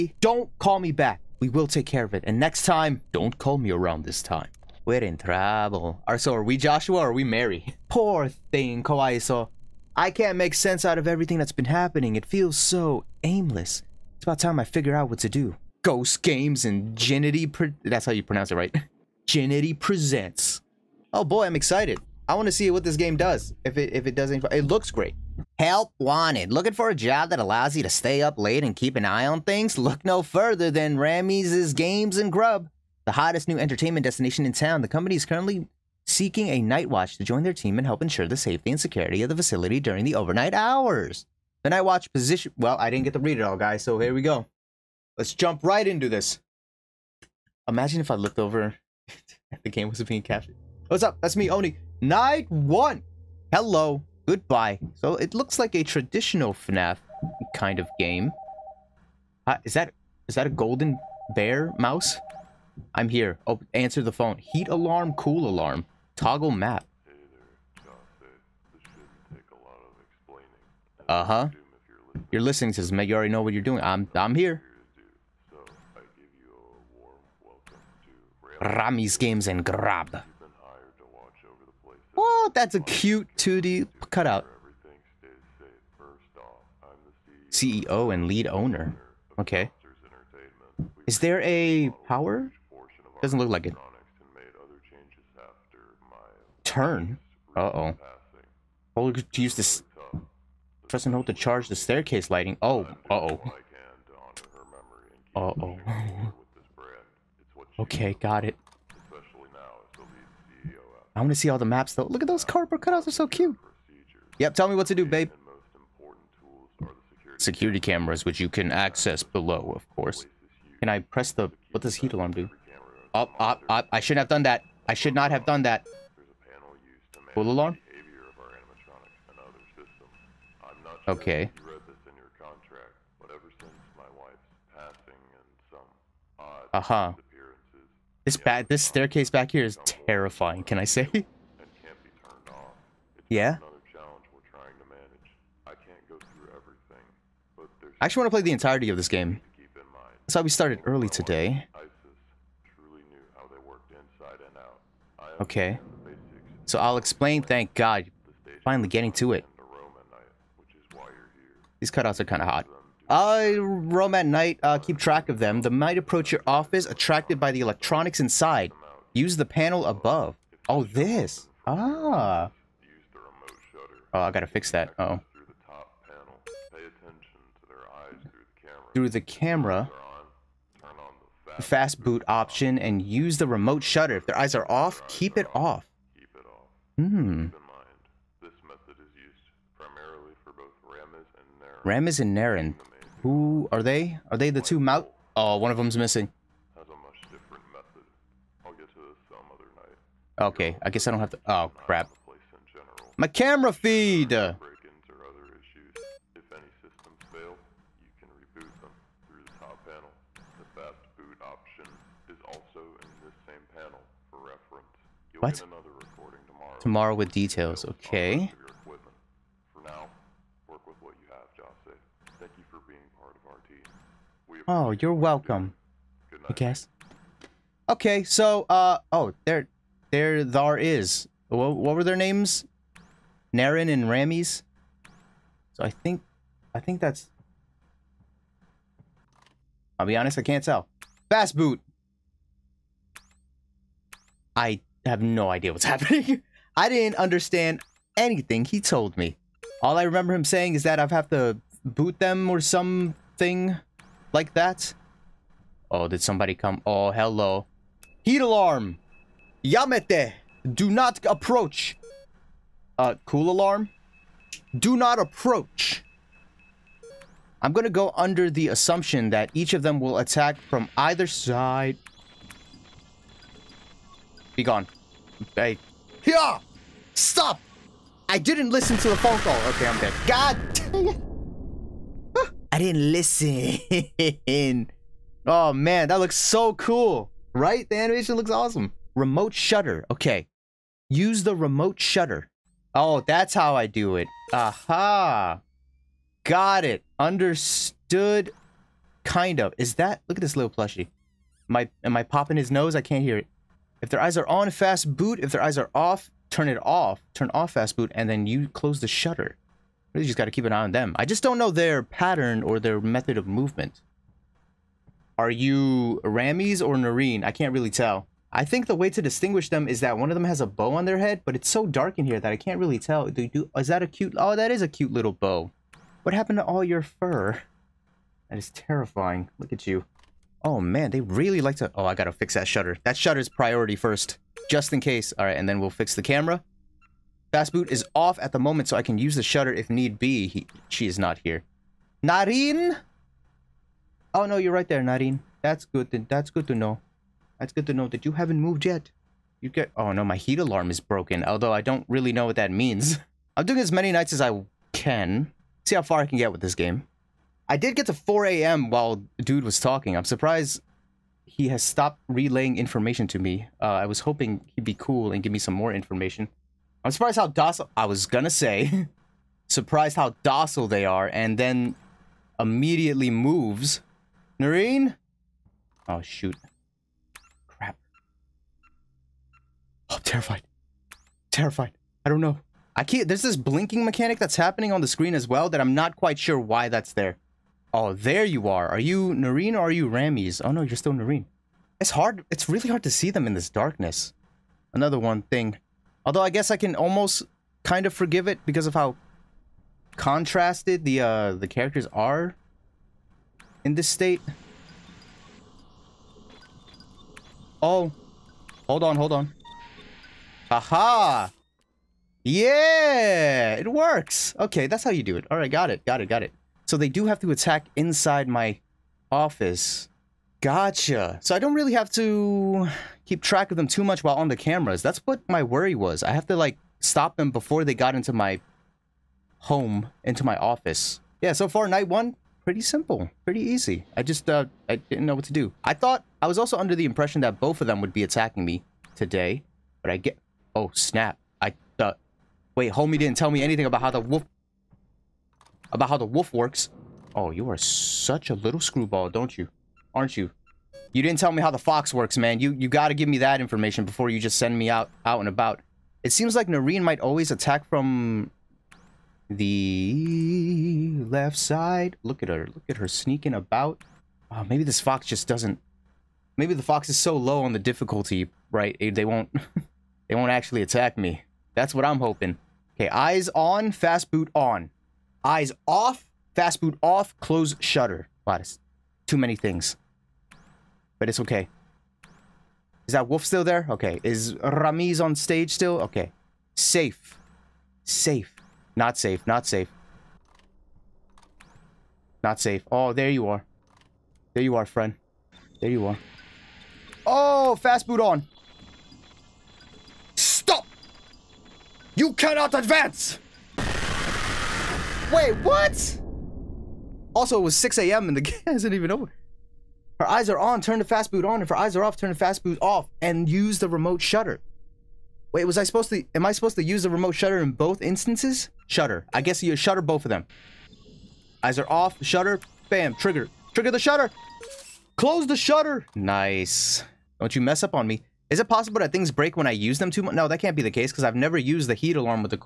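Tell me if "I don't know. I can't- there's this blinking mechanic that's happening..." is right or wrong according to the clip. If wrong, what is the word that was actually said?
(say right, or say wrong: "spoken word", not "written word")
right.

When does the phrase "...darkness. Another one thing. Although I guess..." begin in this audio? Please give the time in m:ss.
6:33.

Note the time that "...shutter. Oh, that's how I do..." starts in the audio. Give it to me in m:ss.
4:51.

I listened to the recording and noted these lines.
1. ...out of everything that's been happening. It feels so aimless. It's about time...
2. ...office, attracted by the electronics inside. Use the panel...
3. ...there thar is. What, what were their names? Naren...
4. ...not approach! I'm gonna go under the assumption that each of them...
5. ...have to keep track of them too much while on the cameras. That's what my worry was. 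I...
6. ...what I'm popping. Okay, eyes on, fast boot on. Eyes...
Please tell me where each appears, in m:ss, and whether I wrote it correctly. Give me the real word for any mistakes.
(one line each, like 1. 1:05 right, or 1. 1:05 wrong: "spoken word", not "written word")
1. 0:10 right
2. 2:46 right
3. 3:50 right
4. 4:24 right
5. 7:01 right
6. 7:51 wrong: "hoping", not "popping".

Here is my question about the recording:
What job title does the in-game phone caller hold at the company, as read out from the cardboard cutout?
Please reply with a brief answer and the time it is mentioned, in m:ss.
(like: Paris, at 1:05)
CEO and lead owner, at 1:27.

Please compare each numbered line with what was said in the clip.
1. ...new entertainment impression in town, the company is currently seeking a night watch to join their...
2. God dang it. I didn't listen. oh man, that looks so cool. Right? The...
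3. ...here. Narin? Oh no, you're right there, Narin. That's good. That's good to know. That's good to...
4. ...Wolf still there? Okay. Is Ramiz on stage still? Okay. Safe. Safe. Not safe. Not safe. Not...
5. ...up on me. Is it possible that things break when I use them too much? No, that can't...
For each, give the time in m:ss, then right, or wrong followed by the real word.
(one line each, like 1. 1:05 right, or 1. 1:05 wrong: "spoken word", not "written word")
1. 0:33 wrong: "destination", not "impression"
2. 4:40 right
3. 5:41 right
4. 8:03 right
5. 8:47 right.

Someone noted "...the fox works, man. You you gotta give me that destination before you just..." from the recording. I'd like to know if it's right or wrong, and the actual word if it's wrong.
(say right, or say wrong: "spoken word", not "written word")
wrong: "information", not "destination".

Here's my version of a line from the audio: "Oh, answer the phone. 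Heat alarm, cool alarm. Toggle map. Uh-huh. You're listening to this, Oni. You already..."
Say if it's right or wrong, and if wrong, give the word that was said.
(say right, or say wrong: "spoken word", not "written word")
wrong: "Meg", not "Oni".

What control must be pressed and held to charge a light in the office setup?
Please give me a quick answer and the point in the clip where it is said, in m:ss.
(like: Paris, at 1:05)
staircase lighting, at 1:41.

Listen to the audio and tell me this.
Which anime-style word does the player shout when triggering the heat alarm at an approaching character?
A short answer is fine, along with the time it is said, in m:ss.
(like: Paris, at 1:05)
Yamete, at 4:19.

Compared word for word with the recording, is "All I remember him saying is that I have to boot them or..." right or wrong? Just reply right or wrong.
right.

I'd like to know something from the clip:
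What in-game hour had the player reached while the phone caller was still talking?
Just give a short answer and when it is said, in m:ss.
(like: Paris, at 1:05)
4 a.m., at 5:58.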